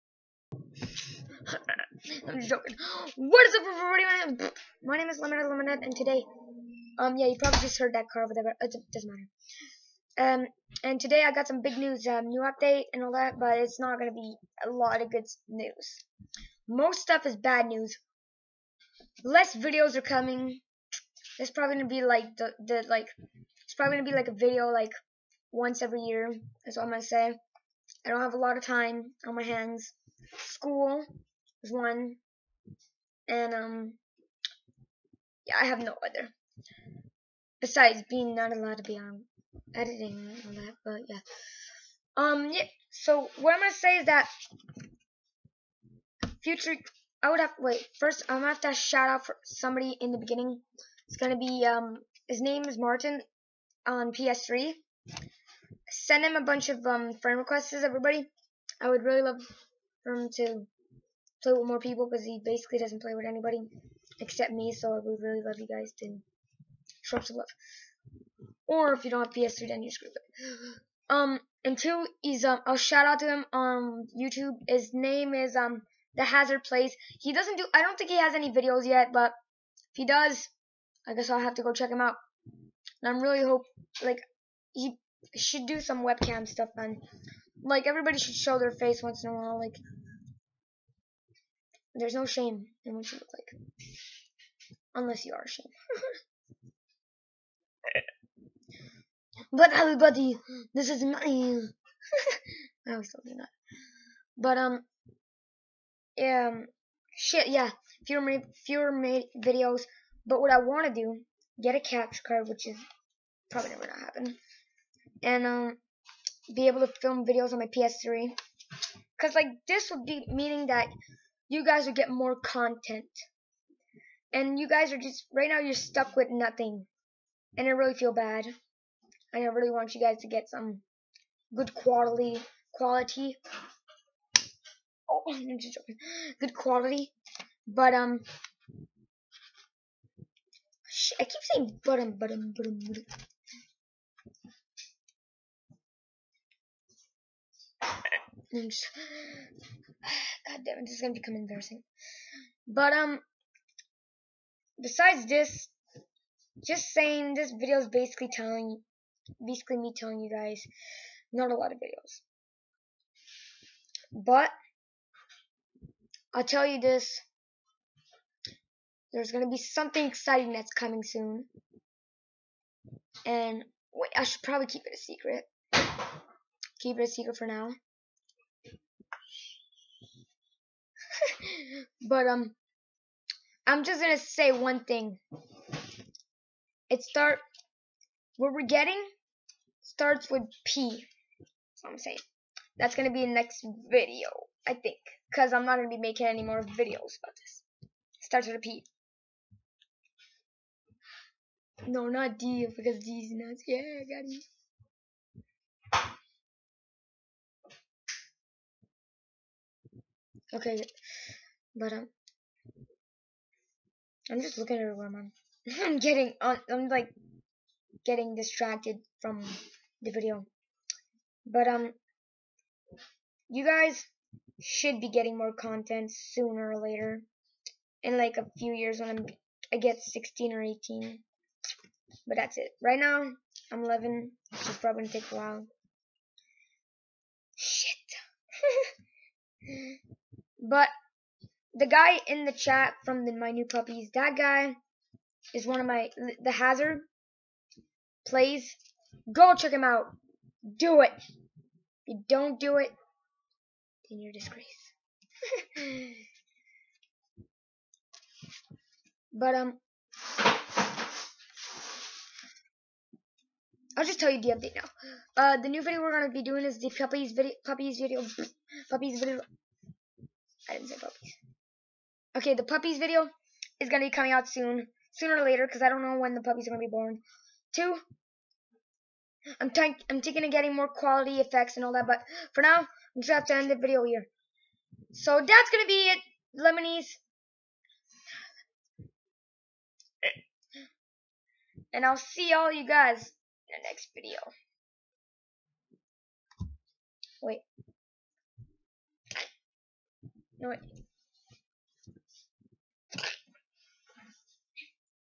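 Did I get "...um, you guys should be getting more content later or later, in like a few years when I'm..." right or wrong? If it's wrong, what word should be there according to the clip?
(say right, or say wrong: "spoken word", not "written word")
wrong: "sooner", not "later".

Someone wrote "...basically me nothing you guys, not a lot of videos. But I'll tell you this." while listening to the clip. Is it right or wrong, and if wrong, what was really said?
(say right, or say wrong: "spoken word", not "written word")
wrong: "telling", not "nothing".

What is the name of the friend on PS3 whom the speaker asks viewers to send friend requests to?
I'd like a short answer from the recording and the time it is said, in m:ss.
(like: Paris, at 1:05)
Martin, at 0:52.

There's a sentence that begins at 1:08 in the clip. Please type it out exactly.
Or if you don't have PS3, then you screw it.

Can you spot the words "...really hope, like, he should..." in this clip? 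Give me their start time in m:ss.
1:23.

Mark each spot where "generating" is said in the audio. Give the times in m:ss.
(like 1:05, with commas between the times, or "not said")
not said.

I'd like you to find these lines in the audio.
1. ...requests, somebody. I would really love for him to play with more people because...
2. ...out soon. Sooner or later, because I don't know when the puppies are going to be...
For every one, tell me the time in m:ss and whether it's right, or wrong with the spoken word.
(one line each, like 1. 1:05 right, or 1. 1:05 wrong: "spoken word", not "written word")
1. 0:57 wrong: "everybody", not "somebody"
2. 4:34 right.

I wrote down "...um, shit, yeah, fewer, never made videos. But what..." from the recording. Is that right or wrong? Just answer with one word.
wrong.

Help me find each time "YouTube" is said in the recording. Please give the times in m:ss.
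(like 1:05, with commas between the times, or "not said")
1:14.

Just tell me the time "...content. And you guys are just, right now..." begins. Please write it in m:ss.
2:02.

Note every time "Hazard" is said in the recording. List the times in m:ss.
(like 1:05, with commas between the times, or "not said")
1:16, 4:06.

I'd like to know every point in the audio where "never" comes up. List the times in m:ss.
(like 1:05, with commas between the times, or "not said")
1:53.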